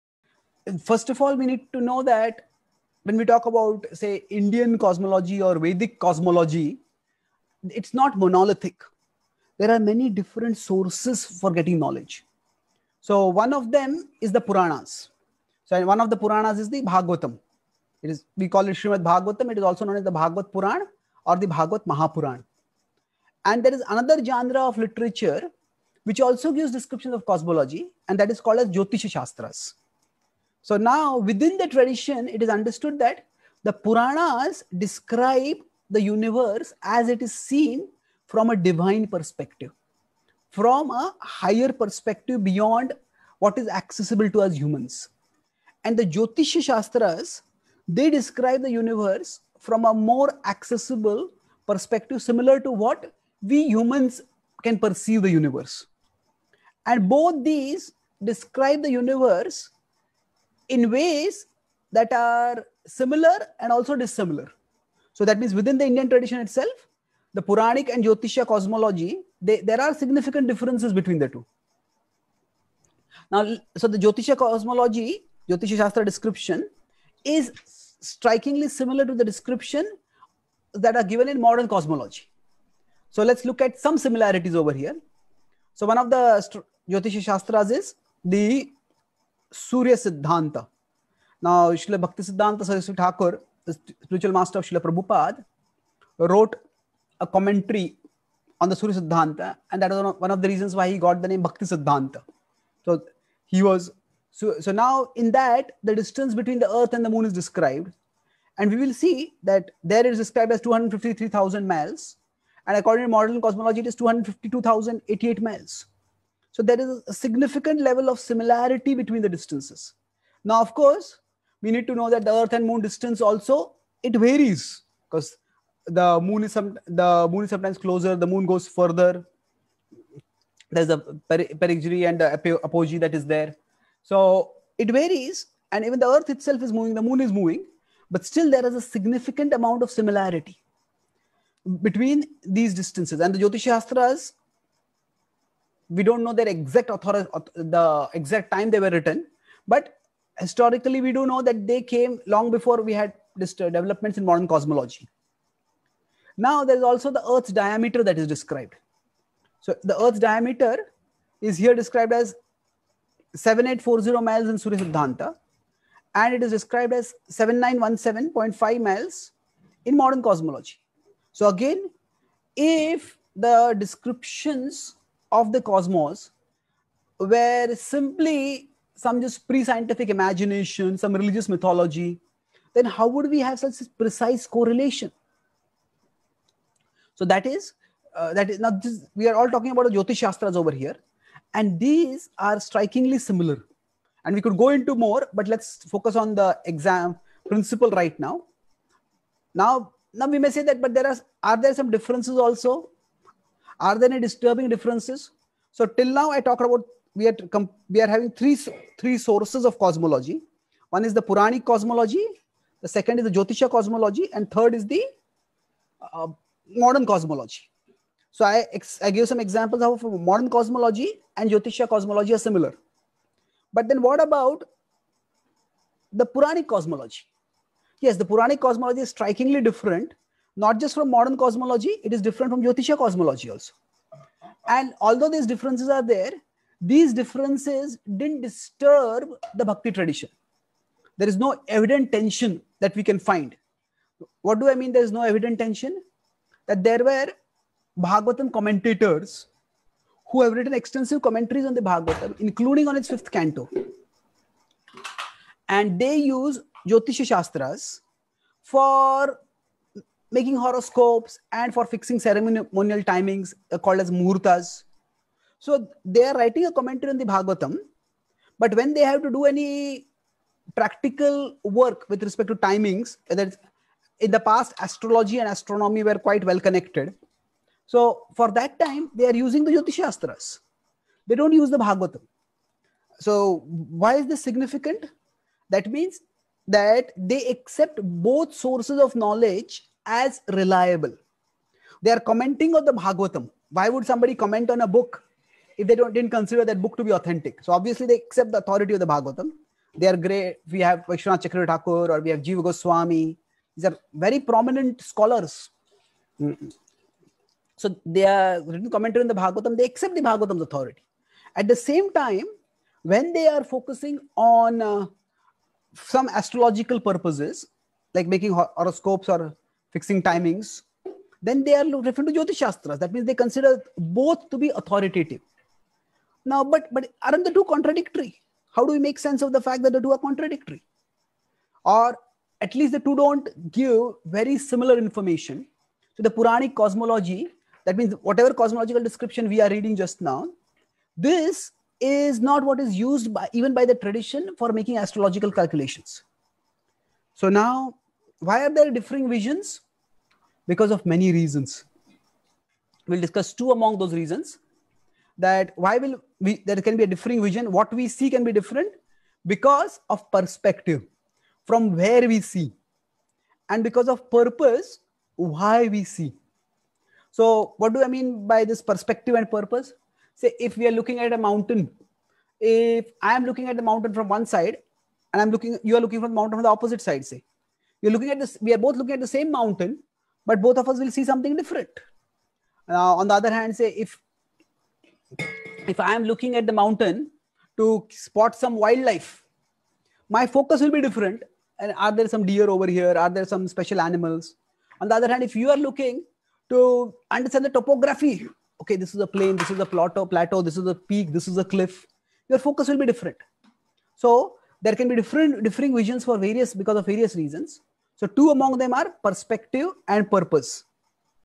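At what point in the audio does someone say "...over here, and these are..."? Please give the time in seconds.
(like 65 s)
190 s.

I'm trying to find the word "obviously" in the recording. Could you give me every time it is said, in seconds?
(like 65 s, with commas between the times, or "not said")
297 s.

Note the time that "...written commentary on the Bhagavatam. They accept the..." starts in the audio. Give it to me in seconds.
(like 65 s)
308 s.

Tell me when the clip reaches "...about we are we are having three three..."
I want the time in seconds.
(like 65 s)
206 s.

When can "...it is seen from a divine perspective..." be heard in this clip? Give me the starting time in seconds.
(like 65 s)
37 s.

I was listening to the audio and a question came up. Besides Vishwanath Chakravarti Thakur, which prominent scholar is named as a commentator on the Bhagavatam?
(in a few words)
Jiva Goswami.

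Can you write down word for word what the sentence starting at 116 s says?
So there is a significant level of similarity between the distances.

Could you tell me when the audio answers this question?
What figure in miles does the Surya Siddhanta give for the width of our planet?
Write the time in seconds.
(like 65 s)
163 s.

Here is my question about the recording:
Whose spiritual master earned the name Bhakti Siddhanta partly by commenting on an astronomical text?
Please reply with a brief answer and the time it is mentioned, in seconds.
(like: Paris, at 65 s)
Srila Prabhupada, at 94 s.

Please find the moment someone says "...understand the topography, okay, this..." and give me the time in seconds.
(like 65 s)
397 s.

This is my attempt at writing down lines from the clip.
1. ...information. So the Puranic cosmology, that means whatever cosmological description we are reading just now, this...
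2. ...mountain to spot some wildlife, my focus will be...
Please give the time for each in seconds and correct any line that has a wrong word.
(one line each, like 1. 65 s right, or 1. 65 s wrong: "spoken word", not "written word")
1. 334 s right
2. 386 s right.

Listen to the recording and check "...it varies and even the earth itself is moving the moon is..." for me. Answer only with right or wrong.
right.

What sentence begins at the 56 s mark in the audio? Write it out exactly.
And both these describe the universe in ways that are similar and also dissimilar.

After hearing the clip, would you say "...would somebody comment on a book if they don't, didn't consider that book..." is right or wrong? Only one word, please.
right.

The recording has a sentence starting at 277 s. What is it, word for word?
So for that time, they are using the Jyoti They don't use the Bhagavatam.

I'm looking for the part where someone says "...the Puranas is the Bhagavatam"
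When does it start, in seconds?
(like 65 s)
16 s.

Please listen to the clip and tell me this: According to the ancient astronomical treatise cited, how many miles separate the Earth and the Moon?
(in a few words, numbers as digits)
253,000 miles.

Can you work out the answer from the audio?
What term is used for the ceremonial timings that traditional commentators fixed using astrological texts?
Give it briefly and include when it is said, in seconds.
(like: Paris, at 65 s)
murtas, at 264 s.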